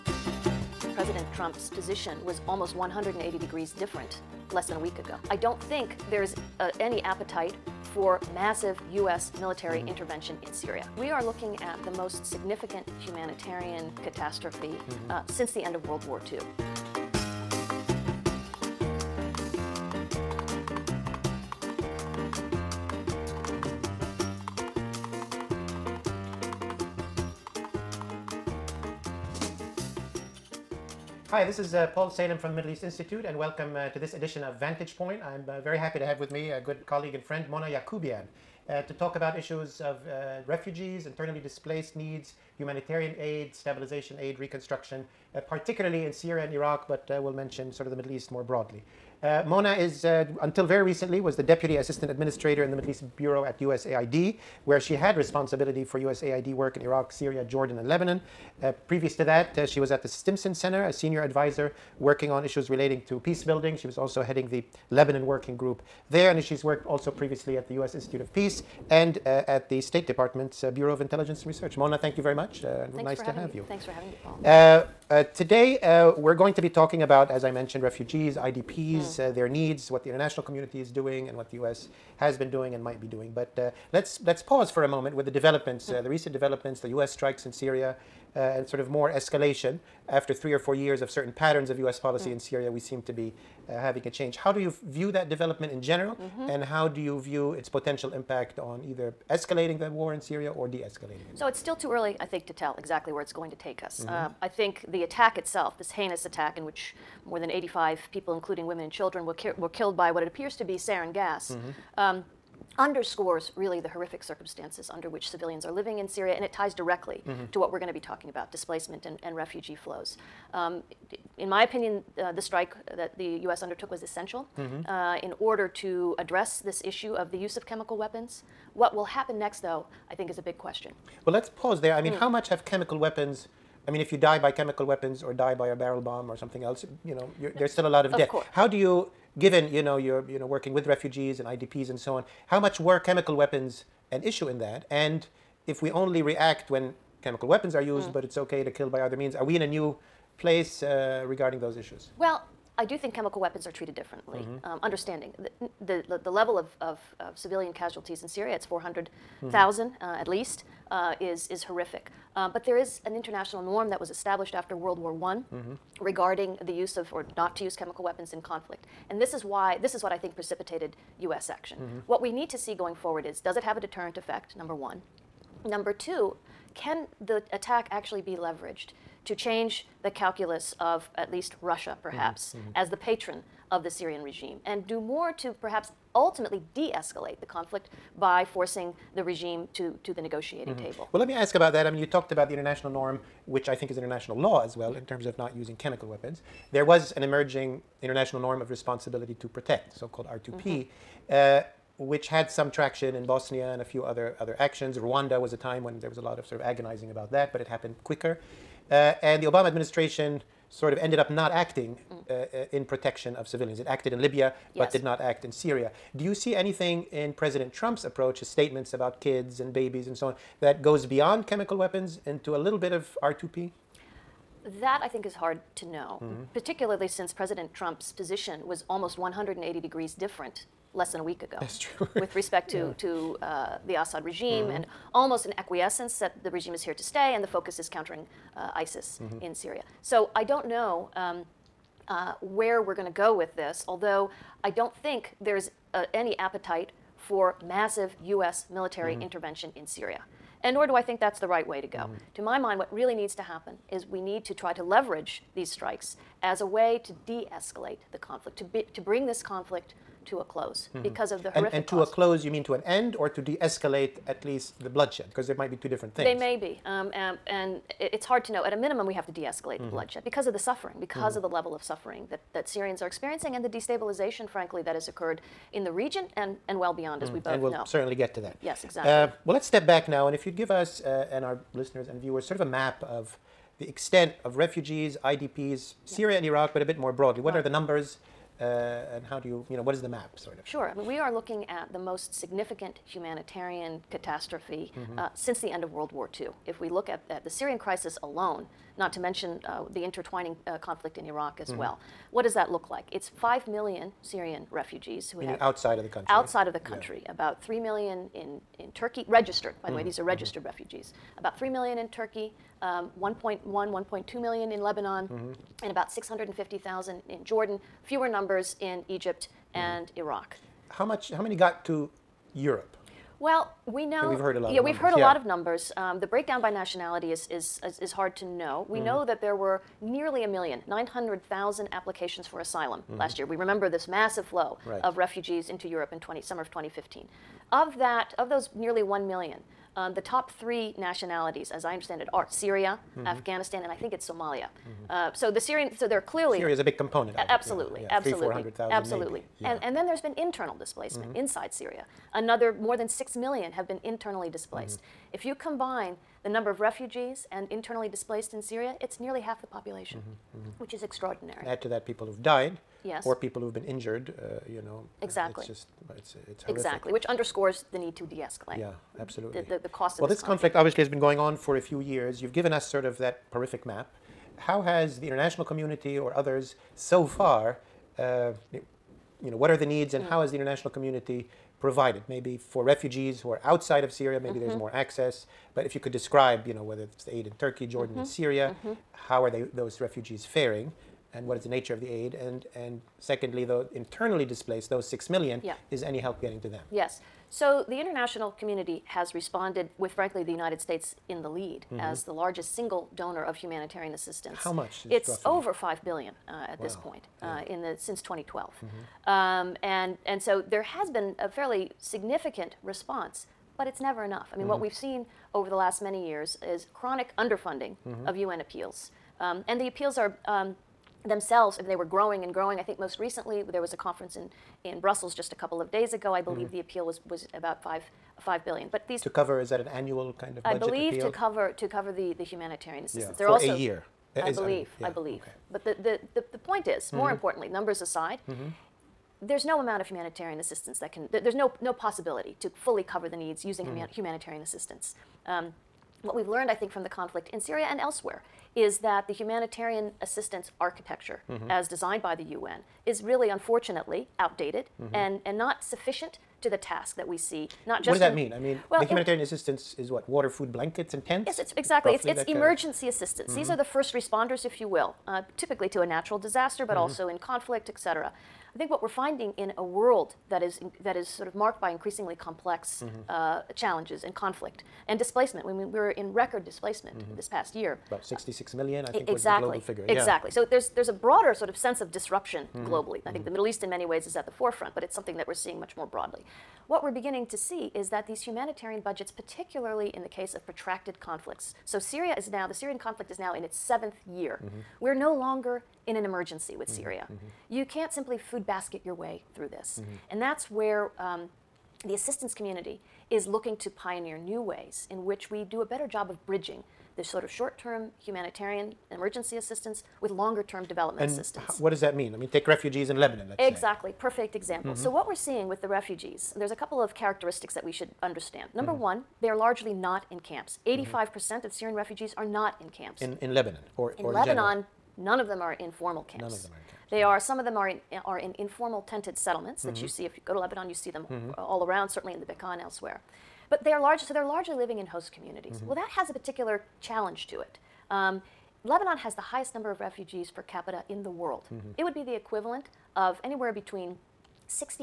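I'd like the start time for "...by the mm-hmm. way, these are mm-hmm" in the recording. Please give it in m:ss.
5:09.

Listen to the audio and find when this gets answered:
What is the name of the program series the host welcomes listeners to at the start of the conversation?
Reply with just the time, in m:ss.
0:34.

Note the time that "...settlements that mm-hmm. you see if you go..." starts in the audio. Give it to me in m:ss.
8:49.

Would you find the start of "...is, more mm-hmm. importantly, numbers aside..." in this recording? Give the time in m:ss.
7:16.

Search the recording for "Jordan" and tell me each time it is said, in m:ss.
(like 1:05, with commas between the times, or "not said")
0:57, 5:17, 6:27.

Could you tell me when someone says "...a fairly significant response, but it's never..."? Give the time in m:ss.
6:51.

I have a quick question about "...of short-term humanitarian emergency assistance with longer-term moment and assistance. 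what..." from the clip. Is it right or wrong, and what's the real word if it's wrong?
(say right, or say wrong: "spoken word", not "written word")
wrong: "development", not "moment".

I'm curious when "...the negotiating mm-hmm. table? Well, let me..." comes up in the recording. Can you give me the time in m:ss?
3:10.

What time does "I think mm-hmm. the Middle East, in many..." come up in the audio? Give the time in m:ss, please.
8:03.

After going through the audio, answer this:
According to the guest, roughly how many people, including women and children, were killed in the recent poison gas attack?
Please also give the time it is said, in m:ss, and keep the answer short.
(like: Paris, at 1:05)
more than 85, at 1:47.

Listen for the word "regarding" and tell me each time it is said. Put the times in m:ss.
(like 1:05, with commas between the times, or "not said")
2:31, 2:46.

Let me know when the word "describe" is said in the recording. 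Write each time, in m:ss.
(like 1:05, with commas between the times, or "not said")
6:26.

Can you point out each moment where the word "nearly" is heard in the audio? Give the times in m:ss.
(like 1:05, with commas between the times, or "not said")
5:30, 5:38, 5:59.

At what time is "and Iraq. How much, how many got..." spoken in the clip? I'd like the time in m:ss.
5:19.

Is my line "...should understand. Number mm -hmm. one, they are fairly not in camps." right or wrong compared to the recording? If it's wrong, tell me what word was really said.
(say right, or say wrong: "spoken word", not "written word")
wrong: "largely", not "fairly".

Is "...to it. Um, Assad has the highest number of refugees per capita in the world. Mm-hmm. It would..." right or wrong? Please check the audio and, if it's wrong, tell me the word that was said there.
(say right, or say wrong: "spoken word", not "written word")
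wrong: "Lebanon", not "Assad".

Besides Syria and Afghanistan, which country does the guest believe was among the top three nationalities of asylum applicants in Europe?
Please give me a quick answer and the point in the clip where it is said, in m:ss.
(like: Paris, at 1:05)
Somalia, at 5:44.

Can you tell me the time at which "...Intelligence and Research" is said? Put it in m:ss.
1:10.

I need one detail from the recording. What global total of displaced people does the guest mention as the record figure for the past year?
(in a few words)
66 million.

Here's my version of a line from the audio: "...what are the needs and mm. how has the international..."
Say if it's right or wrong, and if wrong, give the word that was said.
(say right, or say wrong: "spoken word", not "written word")
right.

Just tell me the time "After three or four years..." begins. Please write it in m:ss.
1:30.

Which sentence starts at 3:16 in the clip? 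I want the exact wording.
There was an emerging International Norm of Responsibility to Protect, so called R2P, mm -hmm.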